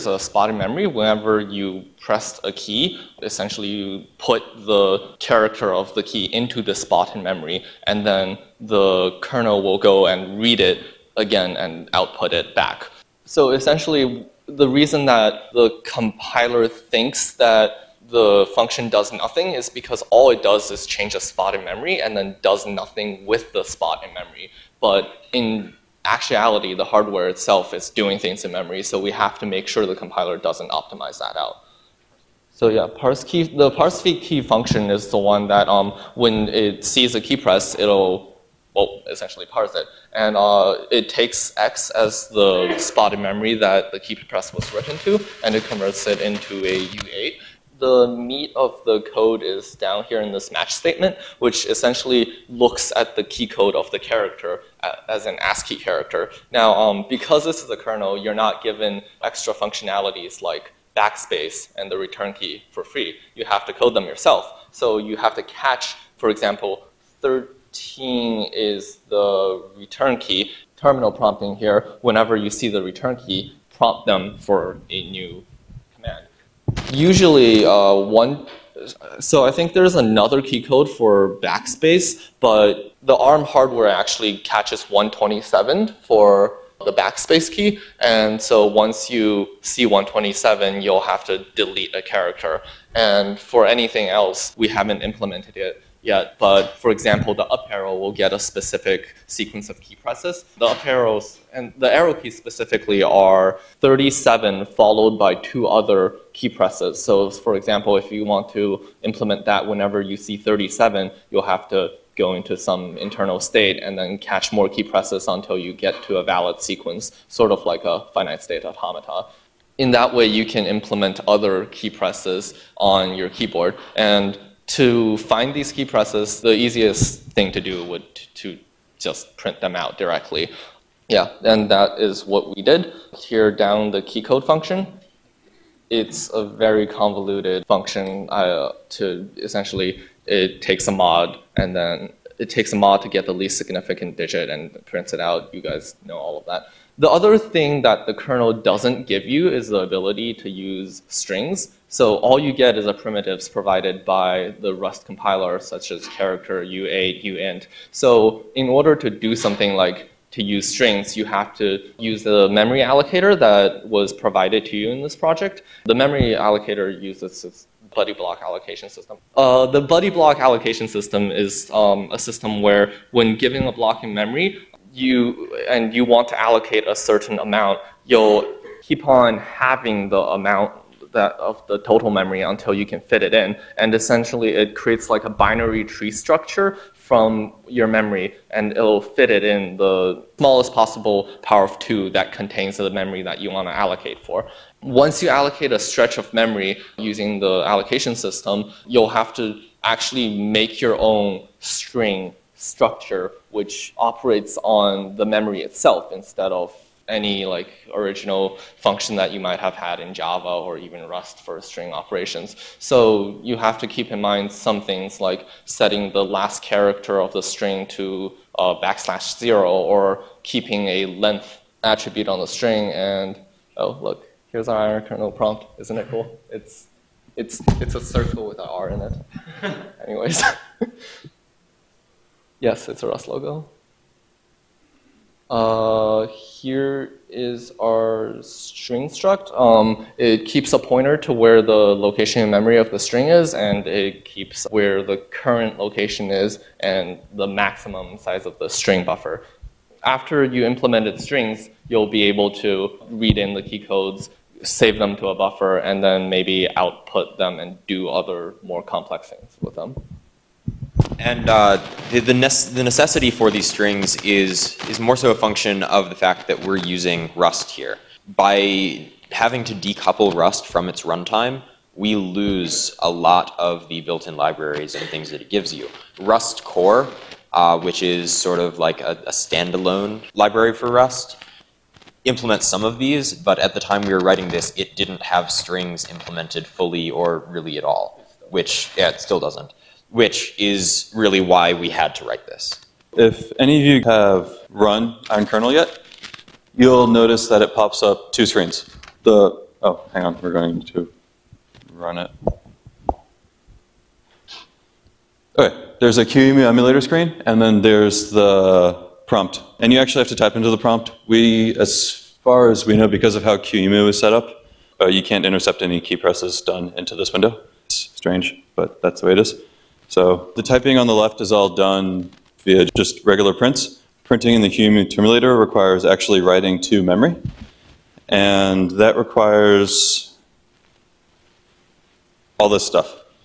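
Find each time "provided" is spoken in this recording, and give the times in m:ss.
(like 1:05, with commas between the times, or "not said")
2:33, 2:44.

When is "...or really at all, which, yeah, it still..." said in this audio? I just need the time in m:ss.
4:47.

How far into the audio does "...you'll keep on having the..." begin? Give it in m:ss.
2:58.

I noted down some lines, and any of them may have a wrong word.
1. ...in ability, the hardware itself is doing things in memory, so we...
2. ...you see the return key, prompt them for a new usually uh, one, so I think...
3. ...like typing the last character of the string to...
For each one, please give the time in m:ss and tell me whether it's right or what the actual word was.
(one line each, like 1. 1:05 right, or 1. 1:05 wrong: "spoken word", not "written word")
1. 0:25 wrong: "actuality", not "ability"
2. 1:12 right
3. 3:35 wrong: "setting", not "typing".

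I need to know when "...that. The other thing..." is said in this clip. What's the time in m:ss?
2:26.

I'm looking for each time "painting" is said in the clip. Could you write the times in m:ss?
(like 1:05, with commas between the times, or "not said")
not said.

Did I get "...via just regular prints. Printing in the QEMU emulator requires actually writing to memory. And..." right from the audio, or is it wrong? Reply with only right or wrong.
right.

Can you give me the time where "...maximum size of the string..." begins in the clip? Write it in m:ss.
4:07.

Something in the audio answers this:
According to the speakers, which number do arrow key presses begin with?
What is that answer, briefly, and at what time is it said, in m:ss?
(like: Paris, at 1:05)
37, at 1:43.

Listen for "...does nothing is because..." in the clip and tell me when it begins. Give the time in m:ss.
0:18.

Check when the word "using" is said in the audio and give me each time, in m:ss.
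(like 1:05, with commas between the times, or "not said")
3:16, 4:26.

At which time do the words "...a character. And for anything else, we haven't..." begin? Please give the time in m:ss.
1:31.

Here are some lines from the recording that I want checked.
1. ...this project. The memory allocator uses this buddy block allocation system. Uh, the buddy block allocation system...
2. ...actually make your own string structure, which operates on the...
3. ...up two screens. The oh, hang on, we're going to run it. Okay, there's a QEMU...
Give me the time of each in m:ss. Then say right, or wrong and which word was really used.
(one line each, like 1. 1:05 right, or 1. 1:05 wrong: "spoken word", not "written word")
1. 2:45 right
2. 3:19 right
3. 4:58 right.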